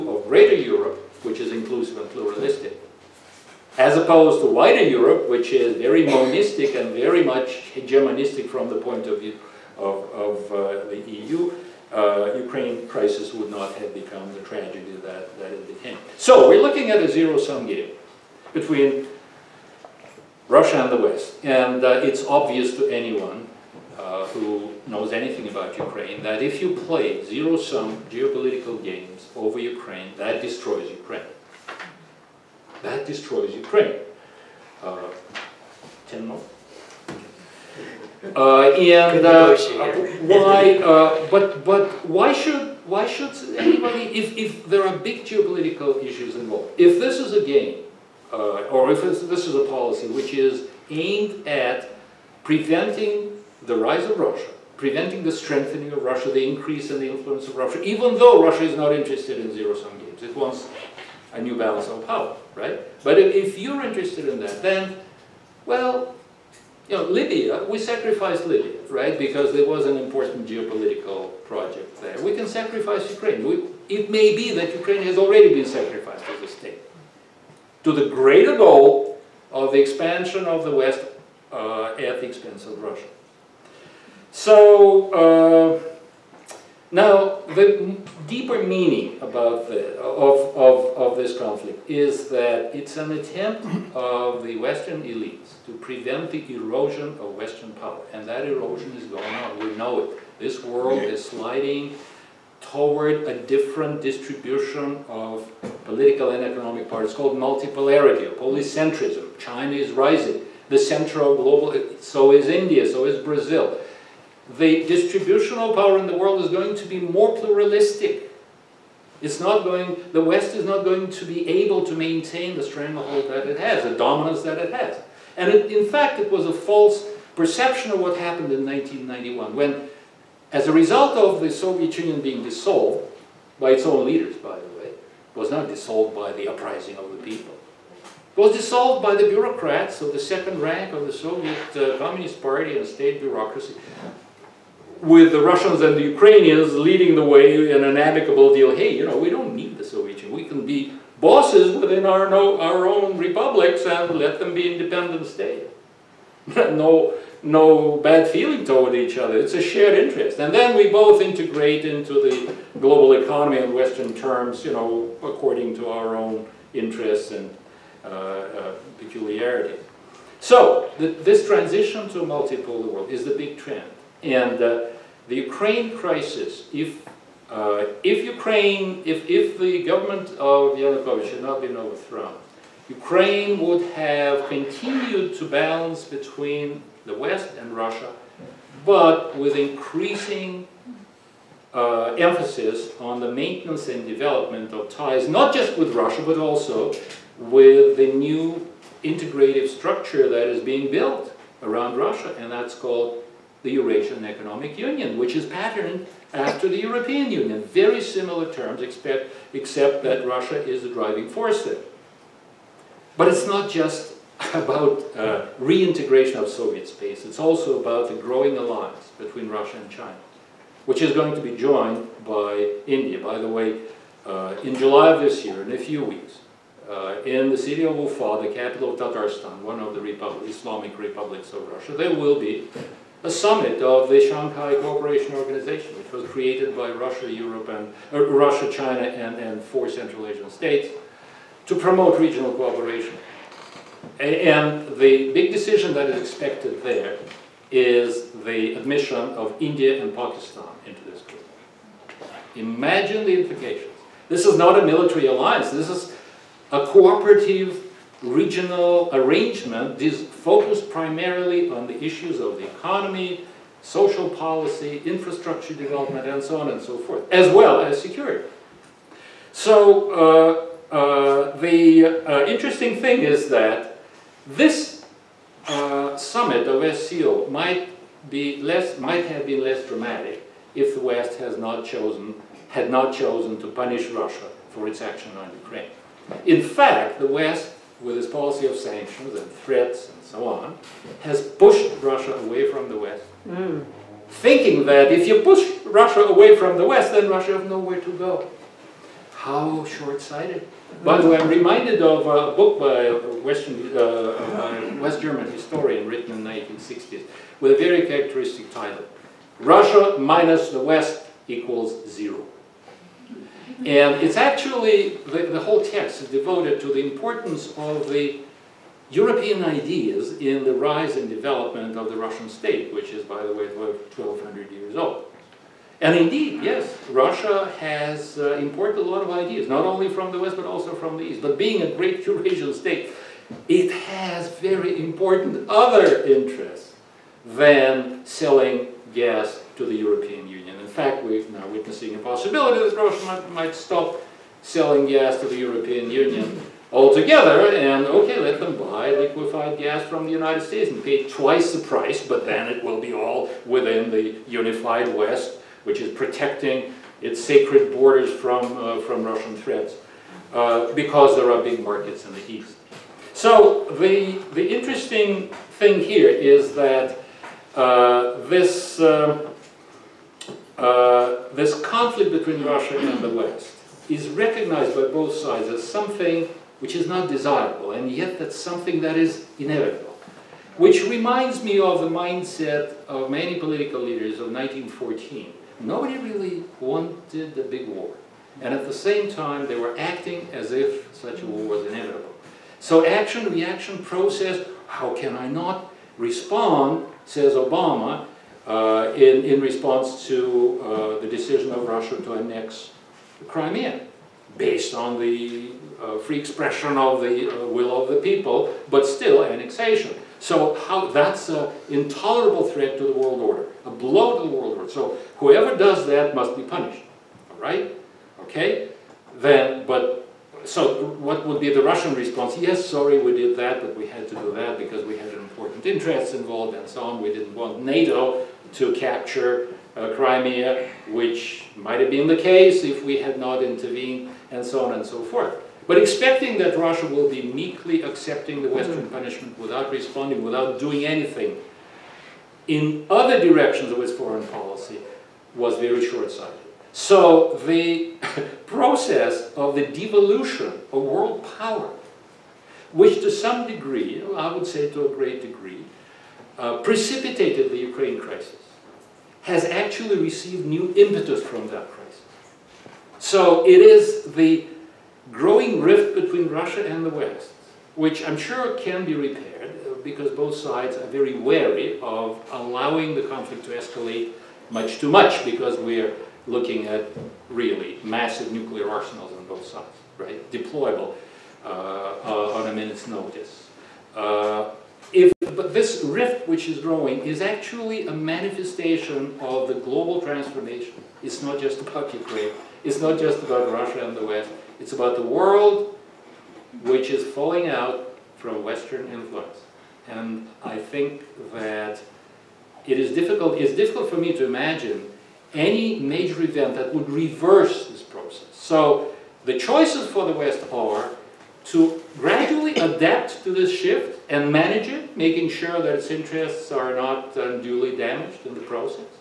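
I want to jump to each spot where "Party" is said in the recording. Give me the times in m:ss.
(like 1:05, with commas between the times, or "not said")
2:22.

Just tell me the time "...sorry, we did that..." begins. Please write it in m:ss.
7:02.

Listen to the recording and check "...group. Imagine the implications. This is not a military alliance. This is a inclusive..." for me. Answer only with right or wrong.
wrong.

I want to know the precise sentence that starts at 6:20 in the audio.
Which reminds me of the mindset of many political leaders of 1914.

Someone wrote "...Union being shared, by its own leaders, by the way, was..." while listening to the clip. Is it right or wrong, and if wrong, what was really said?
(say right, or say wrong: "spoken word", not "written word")
wrong: "dissolved", not "shared".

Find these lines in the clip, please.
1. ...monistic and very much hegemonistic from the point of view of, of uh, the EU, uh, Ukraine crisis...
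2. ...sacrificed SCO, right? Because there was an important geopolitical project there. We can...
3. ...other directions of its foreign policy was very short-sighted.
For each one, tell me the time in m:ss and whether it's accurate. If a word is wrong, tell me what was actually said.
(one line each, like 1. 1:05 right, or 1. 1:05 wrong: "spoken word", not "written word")
1. 0:06 right
2. 1:07 wrong: "Libya", not "SCO"
3. 7:23 right.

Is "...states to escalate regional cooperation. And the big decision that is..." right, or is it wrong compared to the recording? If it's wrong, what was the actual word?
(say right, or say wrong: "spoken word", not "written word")
wrong: "promote", not "escalate".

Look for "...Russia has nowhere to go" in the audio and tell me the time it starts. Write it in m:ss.
4:57.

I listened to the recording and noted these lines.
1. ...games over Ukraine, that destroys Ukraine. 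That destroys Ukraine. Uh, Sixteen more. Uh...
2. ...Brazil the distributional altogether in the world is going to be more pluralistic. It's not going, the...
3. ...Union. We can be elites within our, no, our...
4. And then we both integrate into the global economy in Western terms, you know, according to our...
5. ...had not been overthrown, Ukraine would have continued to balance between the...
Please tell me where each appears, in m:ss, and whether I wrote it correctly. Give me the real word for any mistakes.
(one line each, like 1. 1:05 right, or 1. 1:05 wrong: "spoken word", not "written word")
1. 0:28 wrong: "Ten", not "Sixteen"
2. 1:53 wrong: "power", not "altogether"
3. 2:30 wrong: "bosses", not "elites"
4. 2:40 right
5. 3:01 right.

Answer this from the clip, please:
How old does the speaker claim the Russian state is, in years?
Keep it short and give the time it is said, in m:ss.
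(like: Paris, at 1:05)
1,200, at 5:23.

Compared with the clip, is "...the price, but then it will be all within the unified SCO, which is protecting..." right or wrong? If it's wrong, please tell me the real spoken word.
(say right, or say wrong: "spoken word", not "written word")
wrong: "West", not "SCO".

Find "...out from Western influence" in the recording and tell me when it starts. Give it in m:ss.
8:17.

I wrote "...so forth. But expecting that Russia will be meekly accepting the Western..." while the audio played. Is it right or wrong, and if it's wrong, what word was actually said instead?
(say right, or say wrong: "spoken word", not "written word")
right.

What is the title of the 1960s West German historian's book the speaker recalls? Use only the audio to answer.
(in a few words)
Russia minus the West equals zero.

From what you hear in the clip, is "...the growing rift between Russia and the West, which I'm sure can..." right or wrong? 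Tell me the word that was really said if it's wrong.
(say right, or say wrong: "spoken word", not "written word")
right.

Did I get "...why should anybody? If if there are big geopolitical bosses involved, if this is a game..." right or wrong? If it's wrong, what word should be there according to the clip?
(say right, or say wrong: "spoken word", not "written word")
wrong: "issues", not "bosses".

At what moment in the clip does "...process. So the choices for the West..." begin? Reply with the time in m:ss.
8:28.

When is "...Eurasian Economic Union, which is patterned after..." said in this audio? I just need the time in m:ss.
3:23.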